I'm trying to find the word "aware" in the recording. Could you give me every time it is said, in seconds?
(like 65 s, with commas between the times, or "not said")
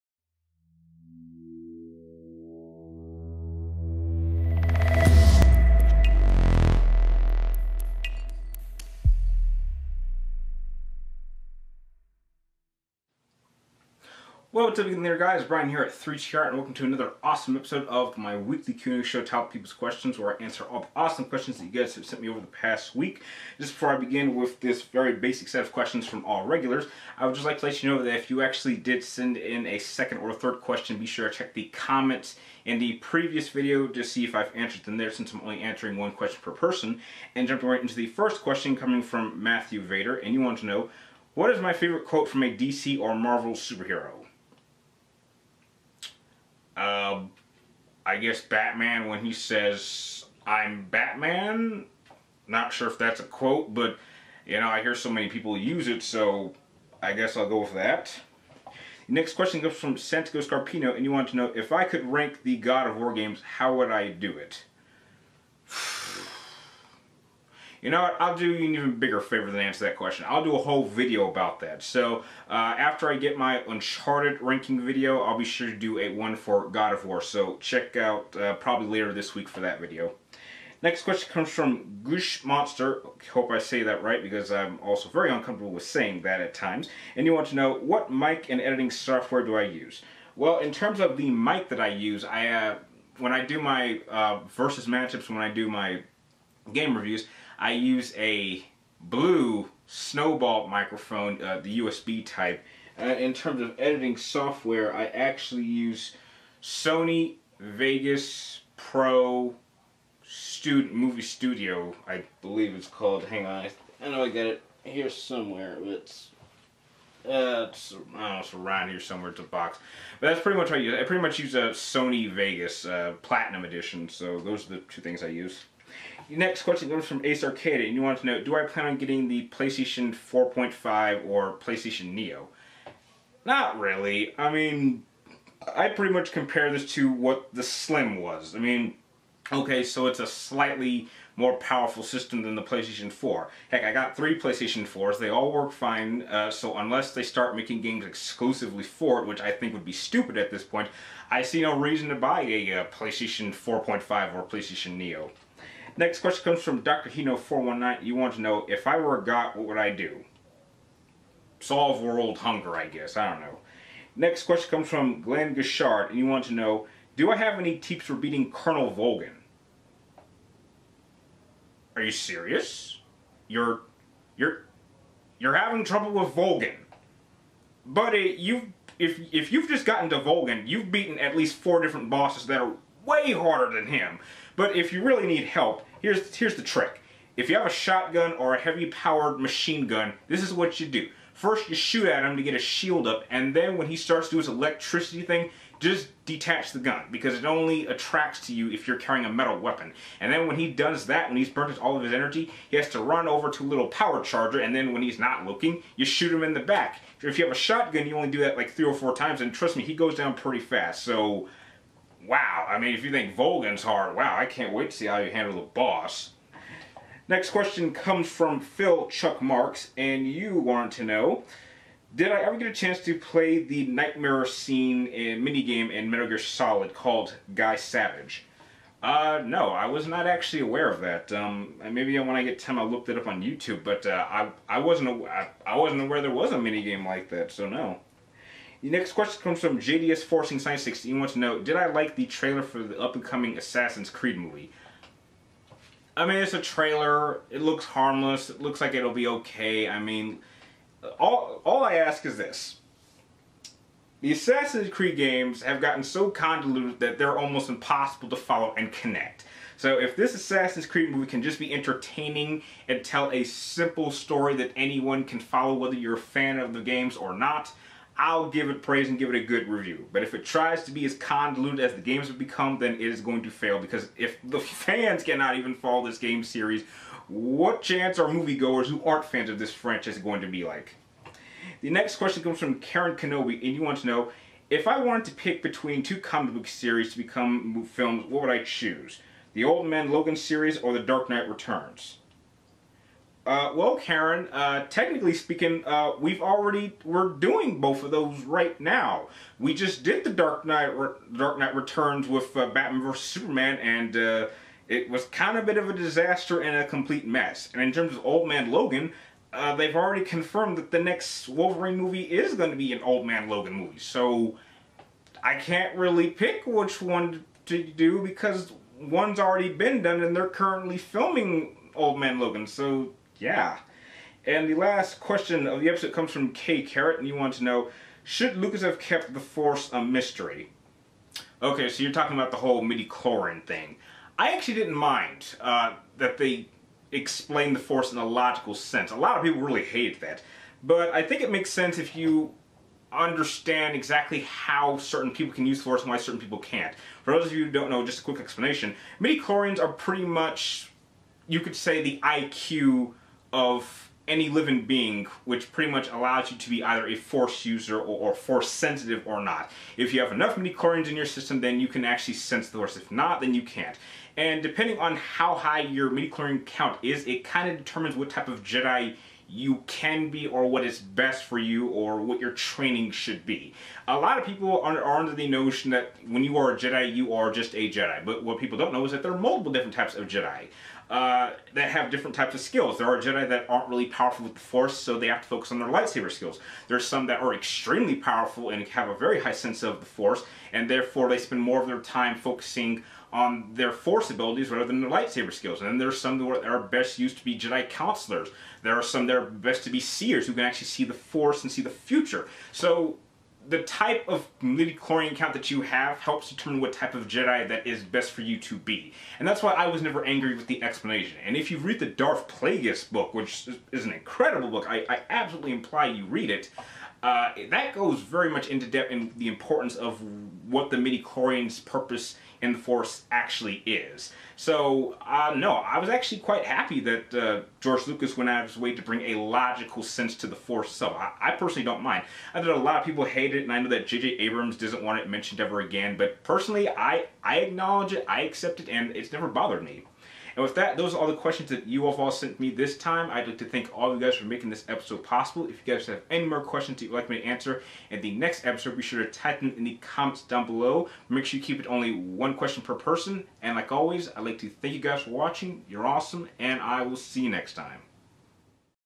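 230 s, 236 s.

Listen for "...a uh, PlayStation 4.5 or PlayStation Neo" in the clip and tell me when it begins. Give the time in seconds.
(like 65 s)
152 s.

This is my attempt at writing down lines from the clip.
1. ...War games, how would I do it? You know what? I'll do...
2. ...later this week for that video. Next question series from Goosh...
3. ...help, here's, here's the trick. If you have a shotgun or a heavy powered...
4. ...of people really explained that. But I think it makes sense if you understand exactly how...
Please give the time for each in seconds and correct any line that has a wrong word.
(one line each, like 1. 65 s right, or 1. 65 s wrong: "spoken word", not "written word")
1. 62 s right
2. 78 s wrong: "comes", not "series"
3. 185 s right
4. 339 s wrong: "hated", not "explained".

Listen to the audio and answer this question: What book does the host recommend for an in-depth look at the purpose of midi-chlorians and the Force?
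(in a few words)
Darth Plagueis.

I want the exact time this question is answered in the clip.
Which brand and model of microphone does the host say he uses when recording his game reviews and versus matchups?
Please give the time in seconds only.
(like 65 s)
98 s.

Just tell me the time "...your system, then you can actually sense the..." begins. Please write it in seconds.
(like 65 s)
361 s.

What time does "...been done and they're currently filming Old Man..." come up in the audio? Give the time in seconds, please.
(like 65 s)
319 s.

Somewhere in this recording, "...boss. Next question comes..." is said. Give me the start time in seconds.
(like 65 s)
215 s.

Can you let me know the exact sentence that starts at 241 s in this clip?
He wants to know, did I like the trailer for the up-and-coming Assassin's Creed movie?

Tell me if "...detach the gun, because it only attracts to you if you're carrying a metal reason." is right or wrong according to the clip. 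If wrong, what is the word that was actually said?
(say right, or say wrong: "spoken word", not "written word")
wrong: "weapon", not "reason".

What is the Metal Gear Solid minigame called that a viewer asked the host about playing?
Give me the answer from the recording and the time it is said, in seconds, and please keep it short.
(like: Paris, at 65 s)
Guy Savage, at 227 s.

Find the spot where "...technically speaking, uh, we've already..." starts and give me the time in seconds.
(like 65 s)
294 s.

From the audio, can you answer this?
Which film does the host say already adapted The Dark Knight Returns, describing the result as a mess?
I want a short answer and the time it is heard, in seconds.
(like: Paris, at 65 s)
Batman vs. Superman, at 302 s.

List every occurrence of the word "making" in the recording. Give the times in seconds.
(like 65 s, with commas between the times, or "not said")
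147 s, 444 s.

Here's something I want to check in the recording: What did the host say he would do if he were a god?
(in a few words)
Solve world hunger.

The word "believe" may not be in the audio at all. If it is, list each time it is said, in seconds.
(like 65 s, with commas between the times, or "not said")
112 s.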